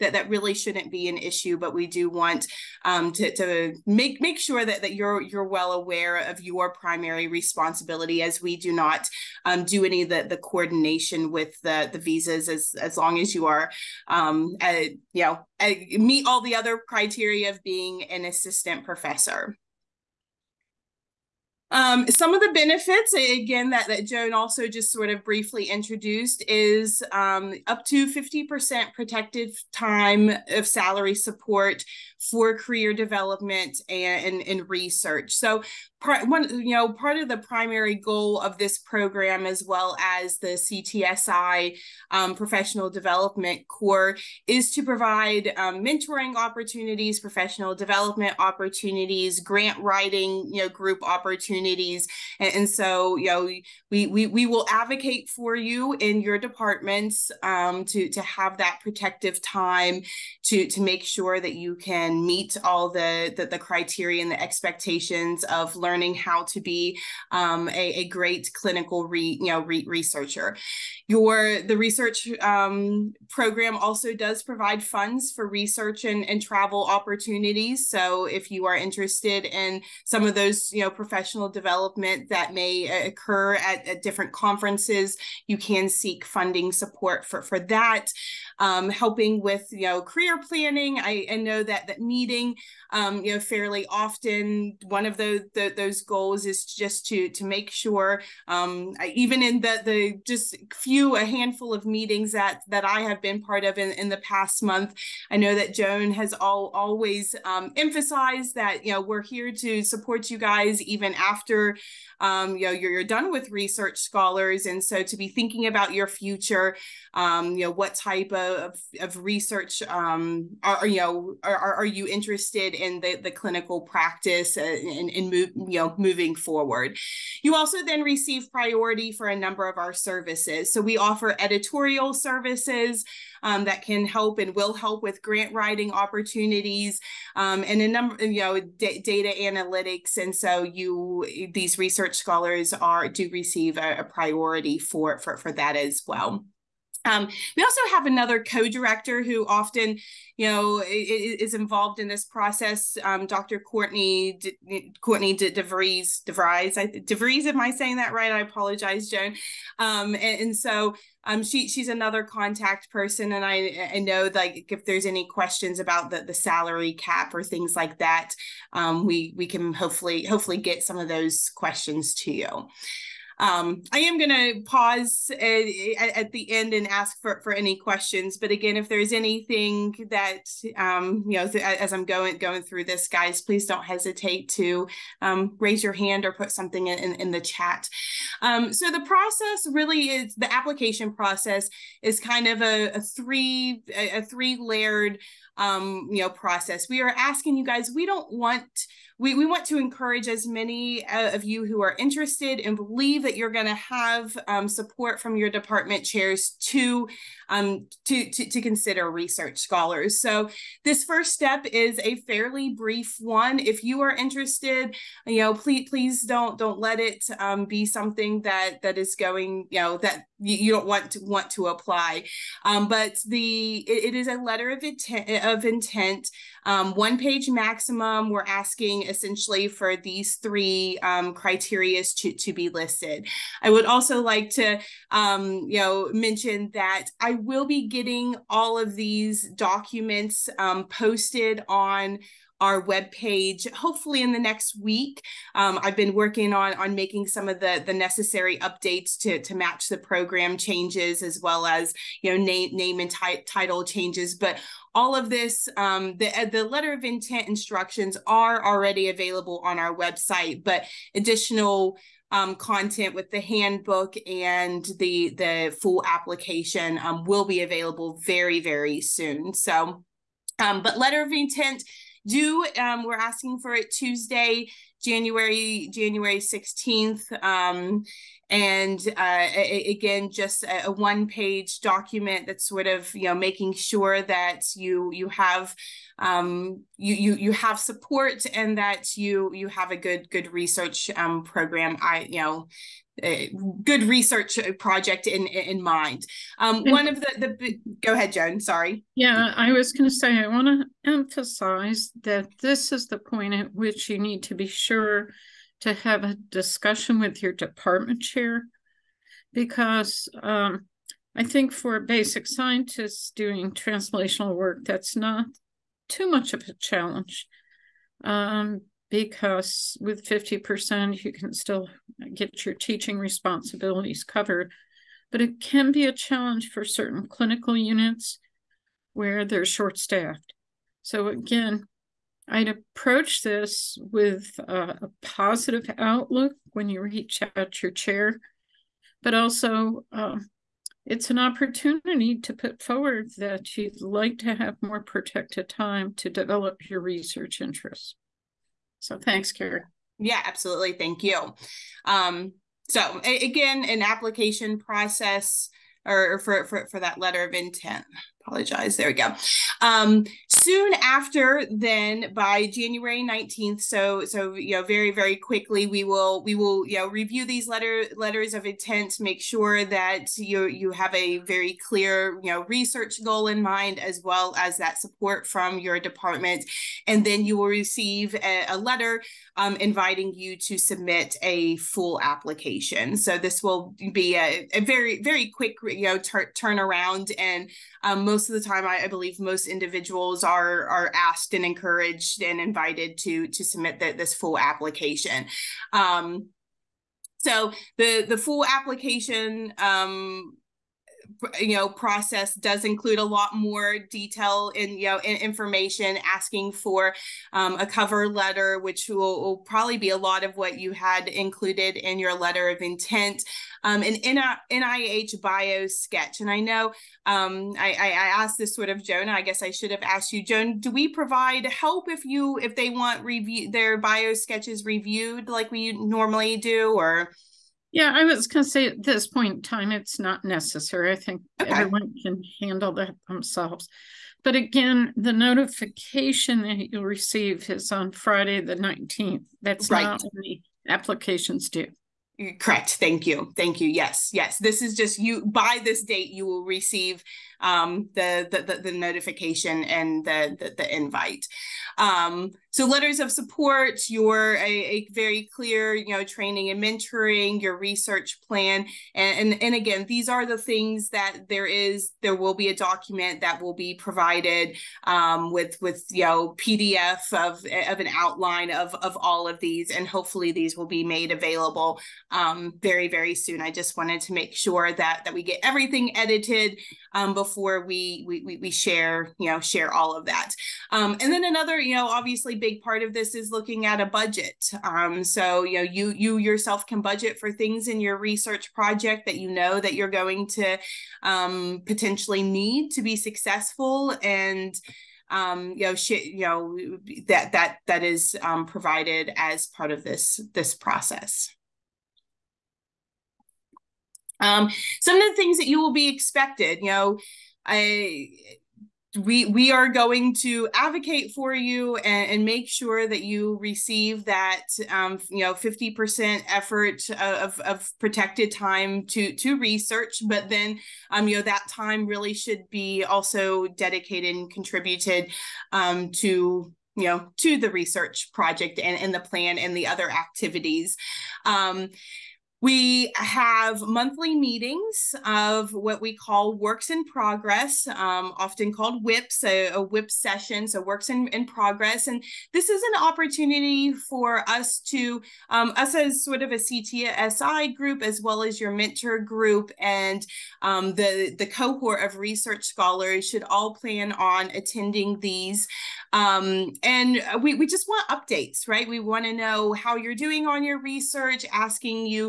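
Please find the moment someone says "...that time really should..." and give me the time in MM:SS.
08:41.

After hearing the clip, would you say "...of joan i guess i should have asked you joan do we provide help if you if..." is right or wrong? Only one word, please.
right.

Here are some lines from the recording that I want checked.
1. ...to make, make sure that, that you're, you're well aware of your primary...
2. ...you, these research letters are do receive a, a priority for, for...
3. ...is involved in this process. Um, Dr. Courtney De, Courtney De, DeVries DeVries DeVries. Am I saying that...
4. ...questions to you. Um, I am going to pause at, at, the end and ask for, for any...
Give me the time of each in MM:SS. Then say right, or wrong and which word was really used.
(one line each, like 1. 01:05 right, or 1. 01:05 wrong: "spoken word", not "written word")
1. 00:03 right
2. 02:20 wrong: "scholars", not "letters"
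3. 02:31 right
4. 02:51 right.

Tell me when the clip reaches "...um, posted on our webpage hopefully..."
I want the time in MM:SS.
04:00.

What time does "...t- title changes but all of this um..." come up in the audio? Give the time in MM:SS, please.
04:13.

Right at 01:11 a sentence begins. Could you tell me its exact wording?
Your the research um, program also does provide funds for research and, and travel opportunities.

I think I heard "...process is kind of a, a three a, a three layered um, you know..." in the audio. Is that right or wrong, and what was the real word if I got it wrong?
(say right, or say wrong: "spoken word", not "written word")
right.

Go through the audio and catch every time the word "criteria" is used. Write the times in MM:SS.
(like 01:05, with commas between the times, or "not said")
00:16, 01:03, 03:51.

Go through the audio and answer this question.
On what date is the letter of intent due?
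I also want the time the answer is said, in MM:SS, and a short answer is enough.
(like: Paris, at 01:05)
January 16, at 04:35.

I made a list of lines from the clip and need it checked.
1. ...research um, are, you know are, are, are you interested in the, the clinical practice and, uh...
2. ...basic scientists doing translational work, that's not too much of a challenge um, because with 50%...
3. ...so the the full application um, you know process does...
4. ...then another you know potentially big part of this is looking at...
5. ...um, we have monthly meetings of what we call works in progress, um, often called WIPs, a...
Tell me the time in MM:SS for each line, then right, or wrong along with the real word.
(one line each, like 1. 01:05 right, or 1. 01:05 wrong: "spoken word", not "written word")
1. 01:59 right
2. 05:11 right
3. 06:37 right
4. 08:01 wrong: "obviously", not "potentially"
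5. 08:51 right.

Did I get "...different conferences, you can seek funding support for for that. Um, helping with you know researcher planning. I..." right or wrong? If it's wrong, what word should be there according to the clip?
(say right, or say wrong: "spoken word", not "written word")
wrong: "career", not "researcher".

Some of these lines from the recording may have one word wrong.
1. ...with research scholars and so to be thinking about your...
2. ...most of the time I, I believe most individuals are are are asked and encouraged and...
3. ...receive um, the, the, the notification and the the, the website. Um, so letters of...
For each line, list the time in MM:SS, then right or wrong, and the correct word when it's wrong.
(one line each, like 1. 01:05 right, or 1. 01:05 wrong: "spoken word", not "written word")
1. 01:53 right
2. 06:28 right
3. 07:26 wrong: "invite", not "website".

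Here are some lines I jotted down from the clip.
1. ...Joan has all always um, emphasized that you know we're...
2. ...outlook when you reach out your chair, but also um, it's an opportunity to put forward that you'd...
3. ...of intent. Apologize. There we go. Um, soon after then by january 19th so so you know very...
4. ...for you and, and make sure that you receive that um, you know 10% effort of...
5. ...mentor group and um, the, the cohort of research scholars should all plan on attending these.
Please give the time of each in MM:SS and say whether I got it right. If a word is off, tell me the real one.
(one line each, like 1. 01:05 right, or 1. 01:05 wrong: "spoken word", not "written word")
1. 01:45 right
2. 05:35 right
3. 05:57 right
4. 08:31 wrong: "50", not "10"
5. 09:08 right.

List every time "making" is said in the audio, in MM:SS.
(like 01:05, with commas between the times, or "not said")
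04:06, 04:43.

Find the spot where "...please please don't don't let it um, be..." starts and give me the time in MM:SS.
03:35.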